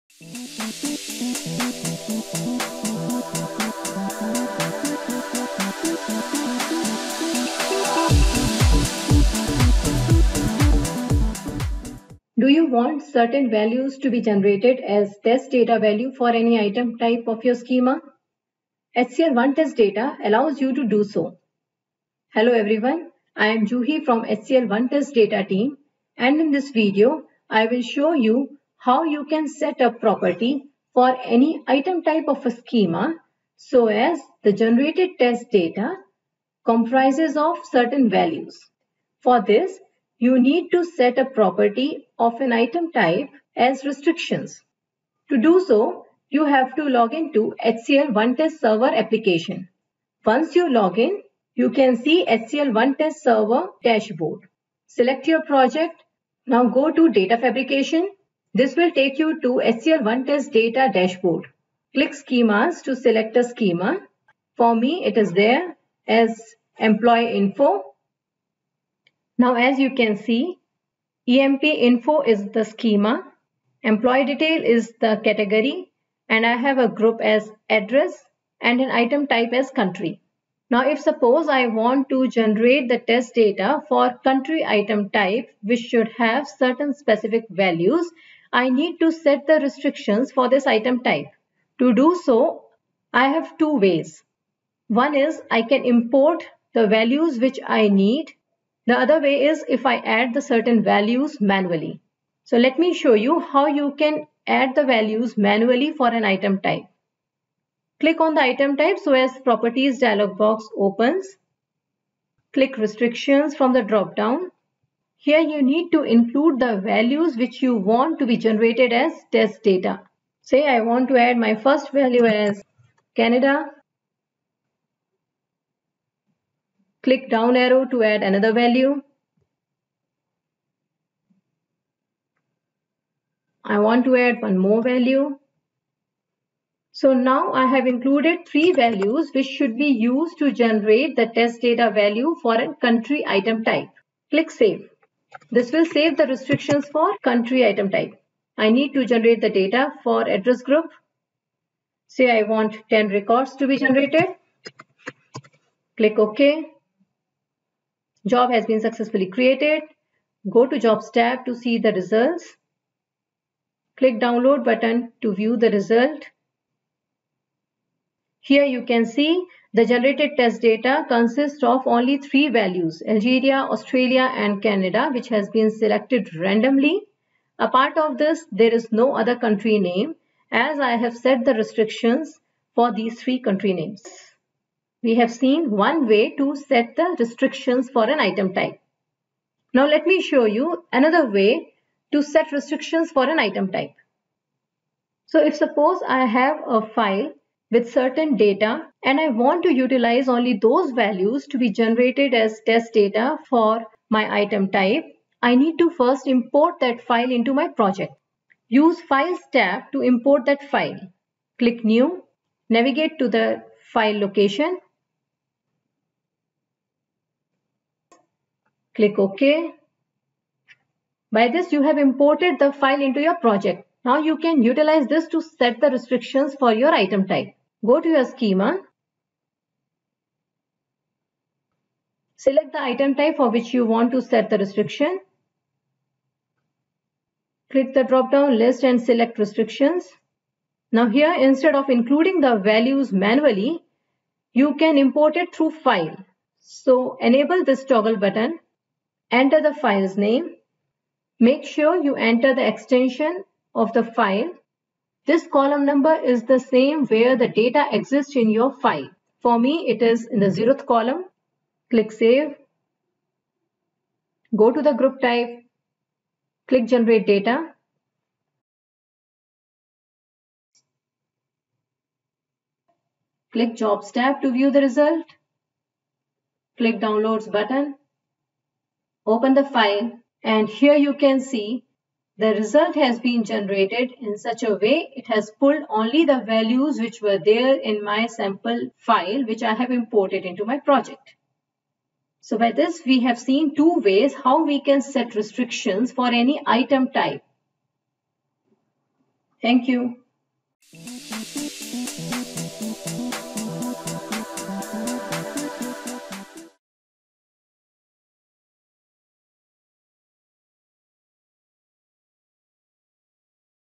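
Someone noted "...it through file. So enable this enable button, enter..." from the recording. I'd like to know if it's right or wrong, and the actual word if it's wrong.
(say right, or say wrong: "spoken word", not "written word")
wrong: "toggle", not "enable".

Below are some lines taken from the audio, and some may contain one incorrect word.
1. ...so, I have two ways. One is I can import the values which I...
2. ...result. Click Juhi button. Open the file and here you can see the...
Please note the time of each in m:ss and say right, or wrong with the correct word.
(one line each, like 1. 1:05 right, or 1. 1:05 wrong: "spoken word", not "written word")
1. 1:32 right
2. 4:34 wrong: "Downloads", not "Juhi".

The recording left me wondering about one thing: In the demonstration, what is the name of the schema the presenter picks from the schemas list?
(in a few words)
Employee info.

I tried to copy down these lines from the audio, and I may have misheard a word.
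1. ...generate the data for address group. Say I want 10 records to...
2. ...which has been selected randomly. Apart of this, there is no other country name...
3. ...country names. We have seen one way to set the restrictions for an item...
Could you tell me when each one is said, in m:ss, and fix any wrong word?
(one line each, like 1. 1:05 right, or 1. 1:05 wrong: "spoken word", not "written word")
1. 2:29 right
2. 2:55 right
3. 3:03 right.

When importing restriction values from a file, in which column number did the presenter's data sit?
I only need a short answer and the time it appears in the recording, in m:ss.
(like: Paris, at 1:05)
0, at 4:20.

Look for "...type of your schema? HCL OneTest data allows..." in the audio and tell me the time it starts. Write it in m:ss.
0:16.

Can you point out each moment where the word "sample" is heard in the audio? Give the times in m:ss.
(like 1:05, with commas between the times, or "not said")
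4:48.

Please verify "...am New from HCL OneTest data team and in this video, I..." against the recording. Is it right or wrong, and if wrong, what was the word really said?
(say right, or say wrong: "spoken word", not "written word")
wrong: "Juhi", not "New".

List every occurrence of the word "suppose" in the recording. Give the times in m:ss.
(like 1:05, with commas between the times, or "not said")
1:20, 3:15.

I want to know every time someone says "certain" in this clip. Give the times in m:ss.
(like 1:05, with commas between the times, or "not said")
0:13, 0:37, 1:26, 1:40, 3:17.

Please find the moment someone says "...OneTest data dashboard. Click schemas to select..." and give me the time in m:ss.
1:00.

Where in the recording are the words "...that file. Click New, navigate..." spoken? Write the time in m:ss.
3:30.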